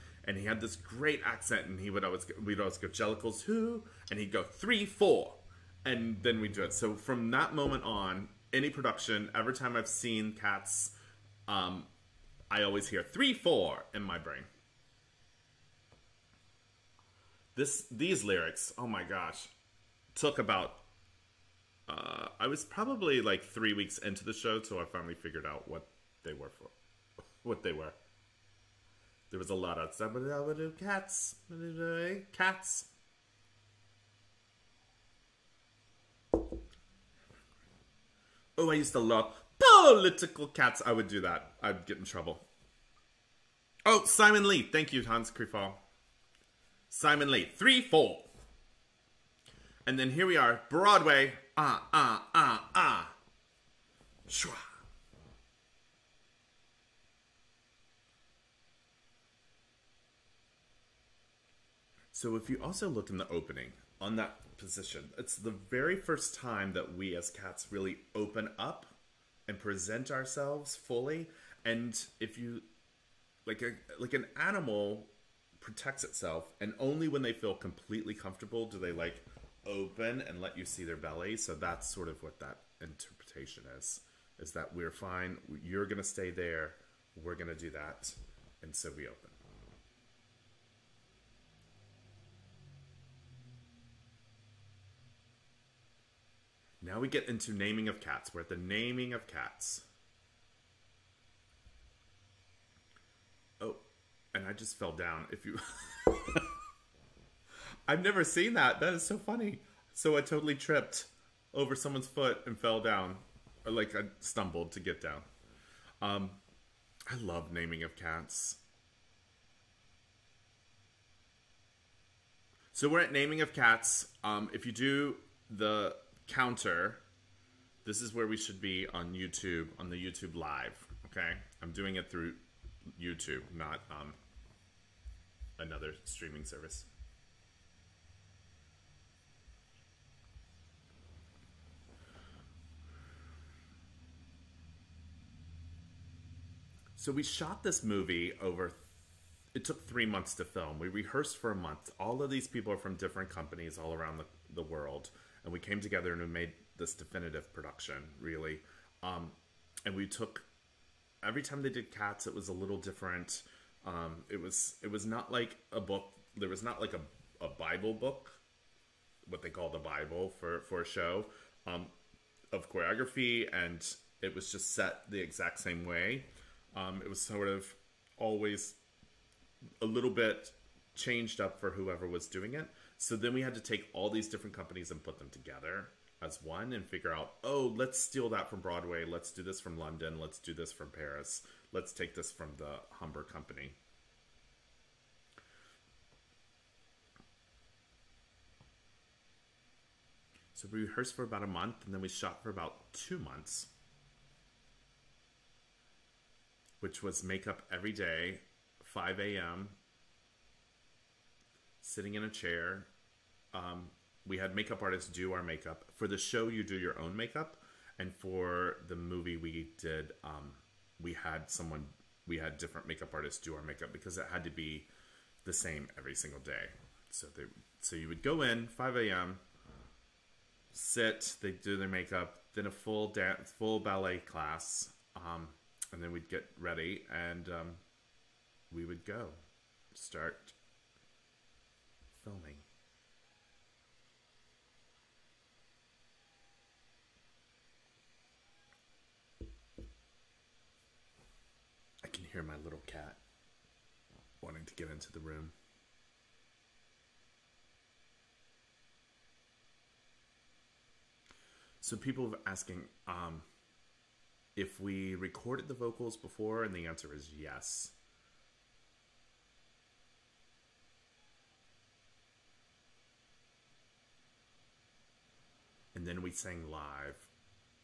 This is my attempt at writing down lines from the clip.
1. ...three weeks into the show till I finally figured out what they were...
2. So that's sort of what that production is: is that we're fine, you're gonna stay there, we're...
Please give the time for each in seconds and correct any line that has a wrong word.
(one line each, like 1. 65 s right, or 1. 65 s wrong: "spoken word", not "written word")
1. 23 s right
2. 81 s wrong: "interpretation", not "production".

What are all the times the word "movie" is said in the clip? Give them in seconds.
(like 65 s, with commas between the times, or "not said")
147 s, 218 s.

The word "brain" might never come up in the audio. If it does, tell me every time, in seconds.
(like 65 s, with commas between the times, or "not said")
14 s.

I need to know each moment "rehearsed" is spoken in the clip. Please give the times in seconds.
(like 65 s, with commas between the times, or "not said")
150 s, 200 s.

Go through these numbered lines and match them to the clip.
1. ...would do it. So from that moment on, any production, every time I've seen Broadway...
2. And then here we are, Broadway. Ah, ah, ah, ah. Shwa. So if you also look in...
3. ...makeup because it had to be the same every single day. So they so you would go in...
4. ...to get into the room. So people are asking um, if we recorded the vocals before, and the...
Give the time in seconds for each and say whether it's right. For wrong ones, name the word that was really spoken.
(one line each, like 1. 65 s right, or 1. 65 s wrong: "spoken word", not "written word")
1. 6 s wrong: "Cats", not "Broadway"
2. 49 s right
3. 223 s right
4. 254 s right.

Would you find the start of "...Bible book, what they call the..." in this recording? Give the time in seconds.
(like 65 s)
167 s.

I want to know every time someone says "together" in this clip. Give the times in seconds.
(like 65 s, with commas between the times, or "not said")
155 s, 185 s.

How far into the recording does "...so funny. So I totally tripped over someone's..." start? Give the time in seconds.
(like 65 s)
109 s.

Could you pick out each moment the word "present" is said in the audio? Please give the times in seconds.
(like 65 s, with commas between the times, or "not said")
69 s.